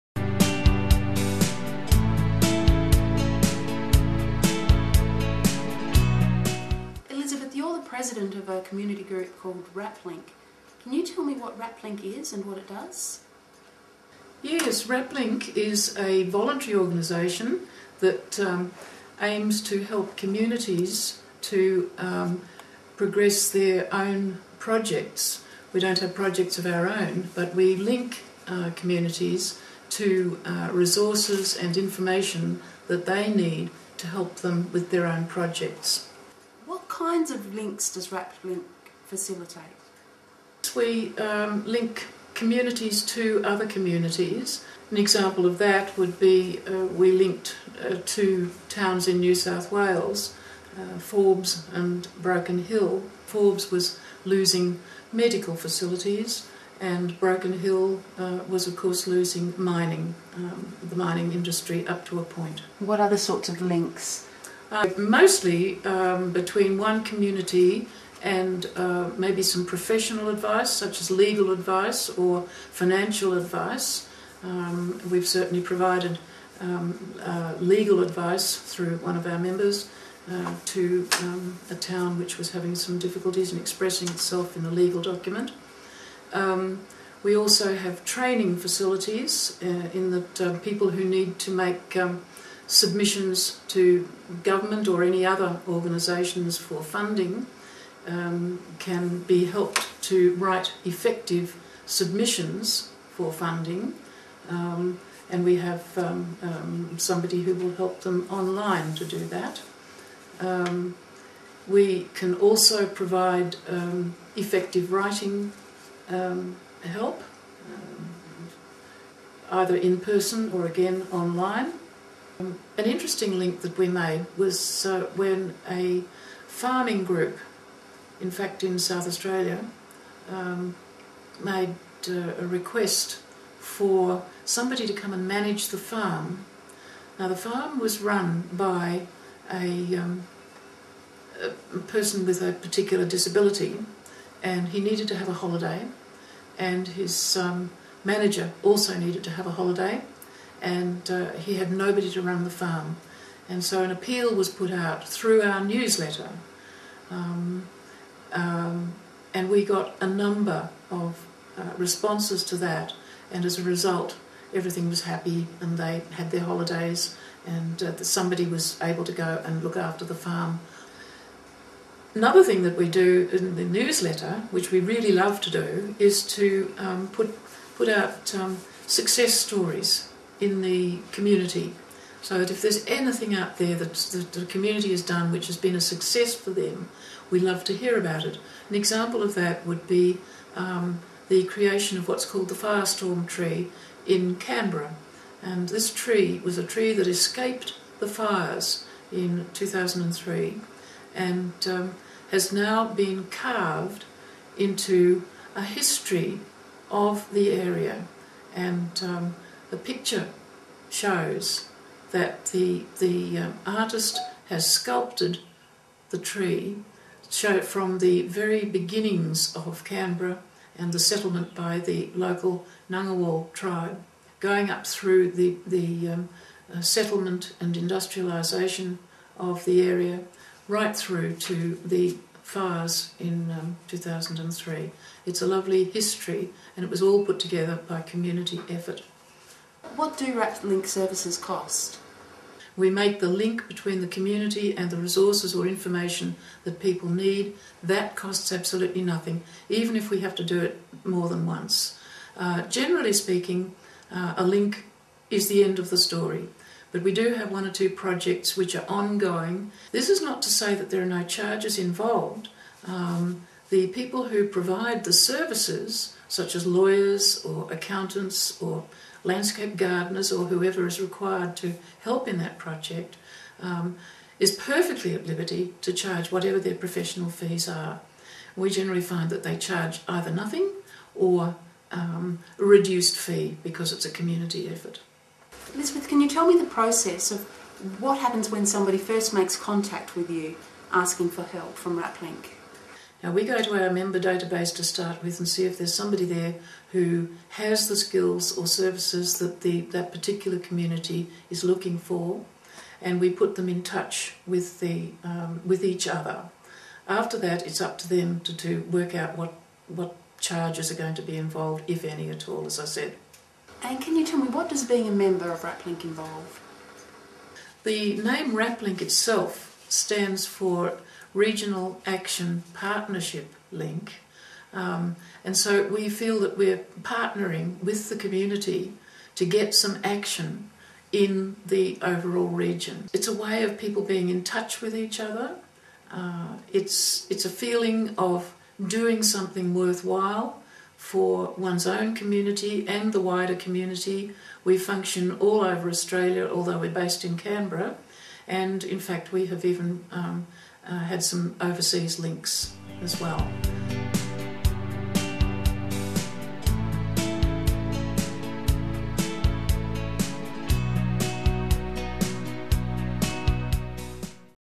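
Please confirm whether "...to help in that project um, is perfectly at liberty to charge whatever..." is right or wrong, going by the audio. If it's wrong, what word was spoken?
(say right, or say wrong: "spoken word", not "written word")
right.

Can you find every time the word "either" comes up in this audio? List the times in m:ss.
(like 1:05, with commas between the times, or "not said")
1:59, 4:40.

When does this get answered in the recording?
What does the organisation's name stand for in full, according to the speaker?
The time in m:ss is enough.
5:21.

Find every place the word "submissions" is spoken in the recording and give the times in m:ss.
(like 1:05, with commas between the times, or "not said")
1:32, 1:41.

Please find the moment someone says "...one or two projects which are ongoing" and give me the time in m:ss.
4:17.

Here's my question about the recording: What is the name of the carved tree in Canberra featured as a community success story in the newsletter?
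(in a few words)
firestorm tree.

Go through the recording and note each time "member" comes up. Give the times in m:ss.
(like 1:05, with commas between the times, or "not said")
1:19, 4:53, 5:15.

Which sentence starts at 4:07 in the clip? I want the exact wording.
That costs absolutely nothing, even if we have to do it more than once.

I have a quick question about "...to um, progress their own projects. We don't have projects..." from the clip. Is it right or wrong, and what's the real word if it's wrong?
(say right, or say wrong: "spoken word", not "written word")
right.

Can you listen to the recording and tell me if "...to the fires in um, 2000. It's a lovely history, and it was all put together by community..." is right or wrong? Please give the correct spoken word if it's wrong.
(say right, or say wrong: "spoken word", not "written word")
wrong: "2003", not "2000".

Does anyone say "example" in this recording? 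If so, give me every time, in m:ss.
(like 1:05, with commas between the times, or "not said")
0:44, 3:08.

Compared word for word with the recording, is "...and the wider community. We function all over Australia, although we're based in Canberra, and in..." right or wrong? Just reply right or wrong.
right.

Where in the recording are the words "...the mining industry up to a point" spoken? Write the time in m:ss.
1:00.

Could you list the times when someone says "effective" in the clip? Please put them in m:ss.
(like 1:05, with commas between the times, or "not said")
1:40, 1:54.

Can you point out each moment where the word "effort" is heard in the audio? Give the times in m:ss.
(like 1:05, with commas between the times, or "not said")
3:58, 4:44.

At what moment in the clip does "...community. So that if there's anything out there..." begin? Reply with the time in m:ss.
3:01.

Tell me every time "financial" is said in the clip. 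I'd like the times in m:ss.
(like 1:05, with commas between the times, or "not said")
1:12.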